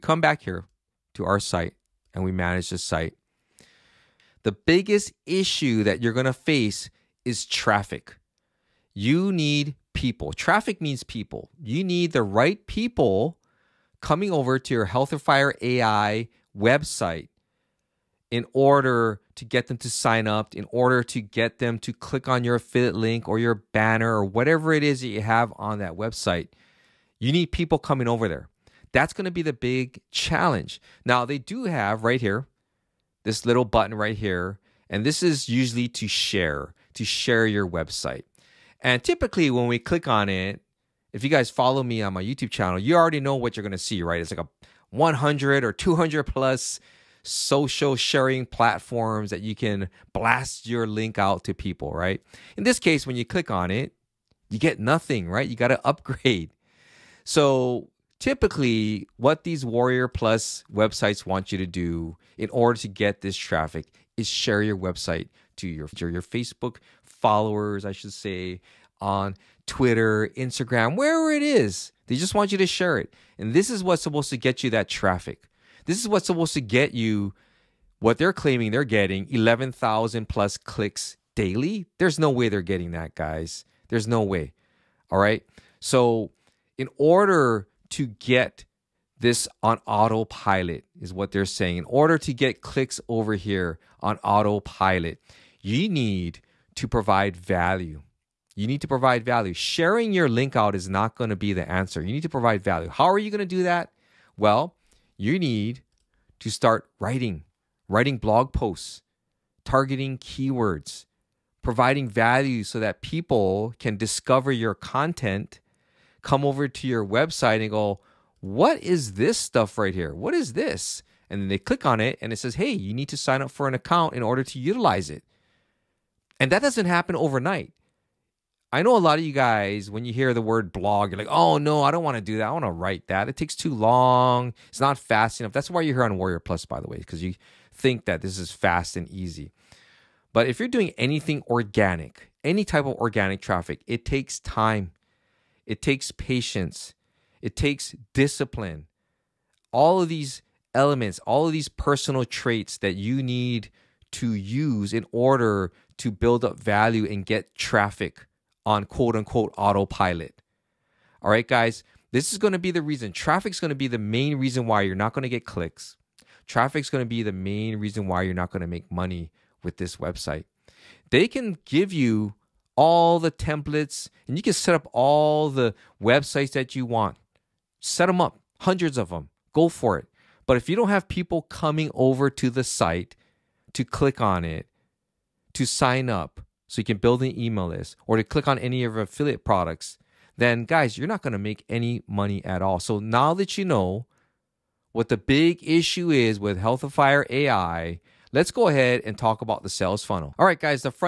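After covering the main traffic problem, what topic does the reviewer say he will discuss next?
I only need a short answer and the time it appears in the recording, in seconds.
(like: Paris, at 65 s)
The sales funnel, at 199 s.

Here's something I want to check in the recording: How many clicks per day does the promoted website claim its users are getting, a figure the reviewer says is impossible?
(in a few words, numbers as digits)
11,000+.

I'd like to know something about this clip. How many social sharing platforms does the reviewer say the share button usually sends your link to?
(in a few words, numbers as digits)
100 or 200+.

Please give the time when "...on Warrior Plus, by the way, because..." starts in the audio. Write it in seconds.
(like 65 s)
136 s.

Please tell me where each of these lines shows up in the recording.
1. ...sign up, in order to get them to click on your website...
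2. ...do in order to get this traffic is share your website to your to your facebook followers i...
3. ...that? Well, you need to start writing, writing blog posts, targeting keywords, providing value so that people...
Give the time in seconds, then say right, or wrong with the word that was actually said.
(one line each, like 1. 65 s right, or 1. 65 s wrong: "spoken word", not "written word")
1. 19 s wrong: "affiliate", not "website"
2. 61 s right
3. 103 s right.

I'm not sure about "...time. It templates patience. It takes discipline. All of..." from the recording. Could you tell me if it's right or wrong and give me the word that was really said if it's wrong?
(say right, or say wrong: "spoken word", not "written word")
wrong: "takes", not "templates".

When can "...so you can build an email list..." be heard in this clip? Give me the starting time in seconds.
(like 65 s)
186 s.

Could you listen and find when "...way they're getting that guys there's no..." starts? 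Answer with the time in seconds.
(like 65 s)
82 s.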